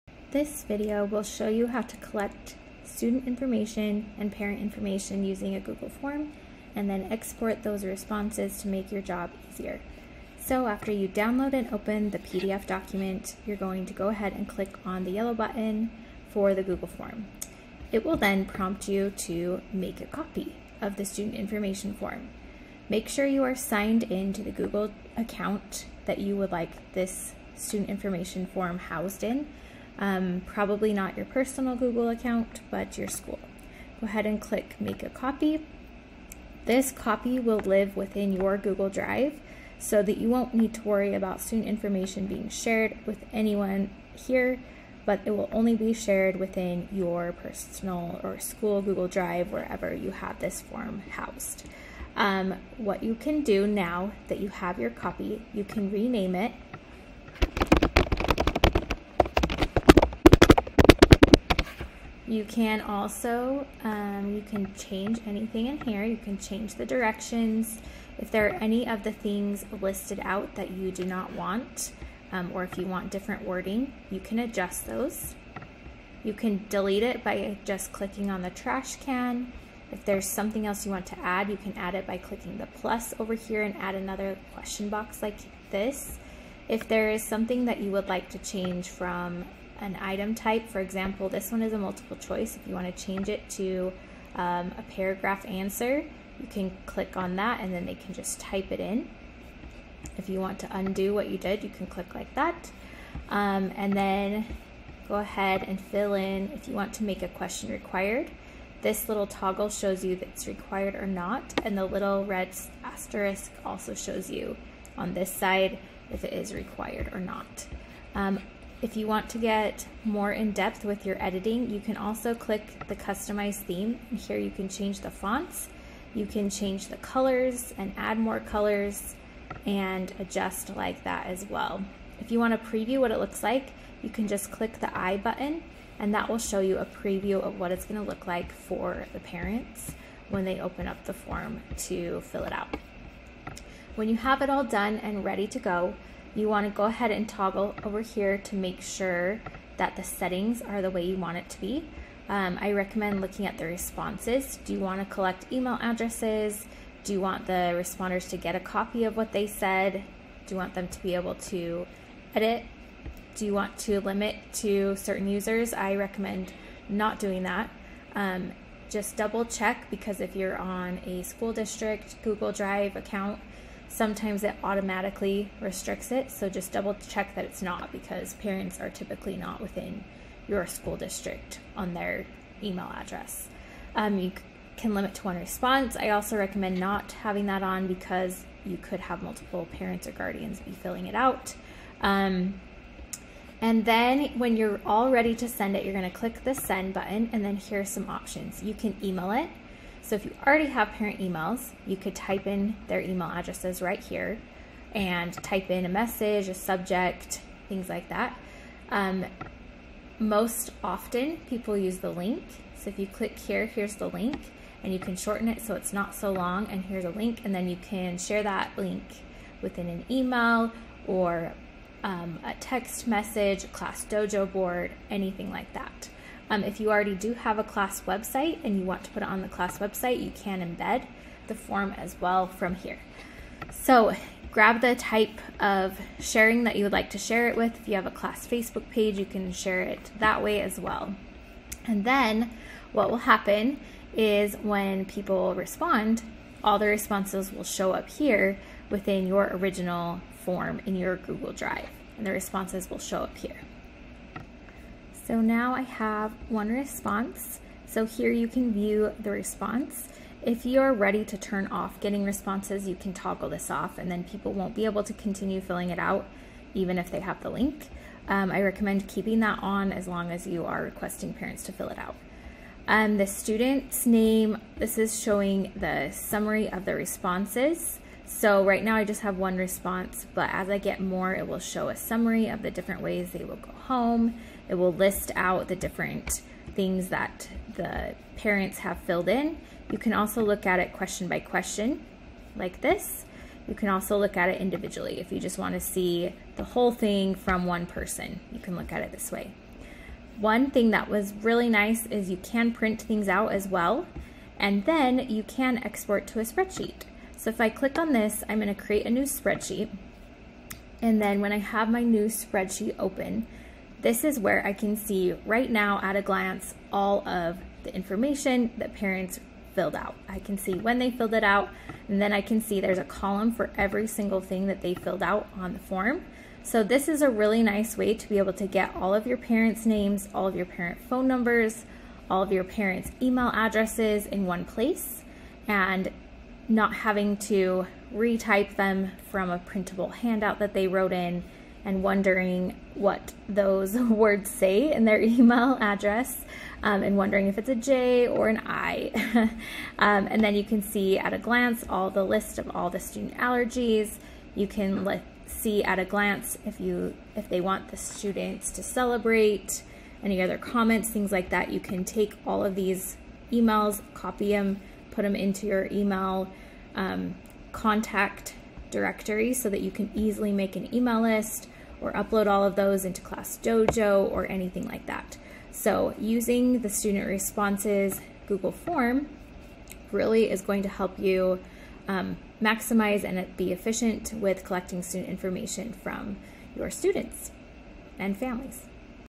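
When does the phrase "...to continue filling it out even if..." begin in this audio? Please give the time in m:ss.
4:25.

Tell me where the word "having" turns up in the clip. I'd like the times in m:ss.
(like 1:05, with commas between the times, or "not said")
3:07, 5:36.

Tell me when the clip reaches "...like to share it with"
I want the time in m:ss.
3:56.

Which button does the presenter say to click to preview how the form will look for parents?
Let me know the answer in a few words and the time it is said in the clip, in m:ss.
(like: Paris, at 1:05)
The I button, at 2:14.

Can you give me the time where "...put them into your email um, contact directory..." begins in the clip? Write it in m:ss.
6:05.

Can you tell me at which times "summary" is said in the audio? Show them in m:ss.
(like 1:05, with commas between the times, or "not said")
4:36, 4:41.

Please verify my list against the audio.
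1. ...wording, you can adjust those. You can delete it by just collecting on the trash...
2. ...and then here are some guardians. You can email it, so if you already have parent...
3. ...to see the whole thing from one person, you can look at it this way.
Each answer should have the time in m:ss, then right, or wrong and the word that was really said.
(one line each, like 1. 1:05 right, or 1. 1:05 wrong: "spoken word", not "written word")
1. 1:13 wrong: "clicking", not "collecting"
2. 3:17 wrong: "options", not "guardians"
3. 4:55 right.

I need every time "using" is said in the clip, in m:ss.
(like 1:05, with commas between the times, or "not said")
0:05, 6:16.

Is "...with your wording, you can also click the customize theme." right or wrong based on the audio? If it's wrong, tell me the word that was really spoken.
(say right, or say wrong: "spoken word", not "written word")
wrong: "editing", not "wording".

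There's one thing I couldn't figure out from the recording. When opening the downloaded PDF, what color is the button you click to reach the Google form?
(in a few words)
Yellow.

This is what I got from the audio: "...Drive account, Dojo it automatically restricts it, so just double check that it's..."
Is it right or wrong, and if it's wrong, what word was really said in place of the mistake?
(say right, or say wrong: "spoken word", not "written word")
wrong: "Sometimes", not "Dojo".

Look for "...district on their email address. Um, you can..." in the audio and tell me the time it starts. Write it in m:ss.
3:00.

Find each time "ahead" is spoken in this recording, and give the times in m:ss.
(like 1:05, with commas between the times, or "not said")
0:14, 0:34, 1:45, 2:26.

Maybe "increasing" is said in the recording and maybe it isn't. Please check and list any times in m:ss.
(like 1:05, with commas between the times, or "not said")
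not said.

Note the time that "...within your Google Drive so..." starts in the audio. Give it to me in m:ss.
0:37.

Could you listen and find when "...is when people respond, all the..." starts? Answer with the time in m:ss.
4:04.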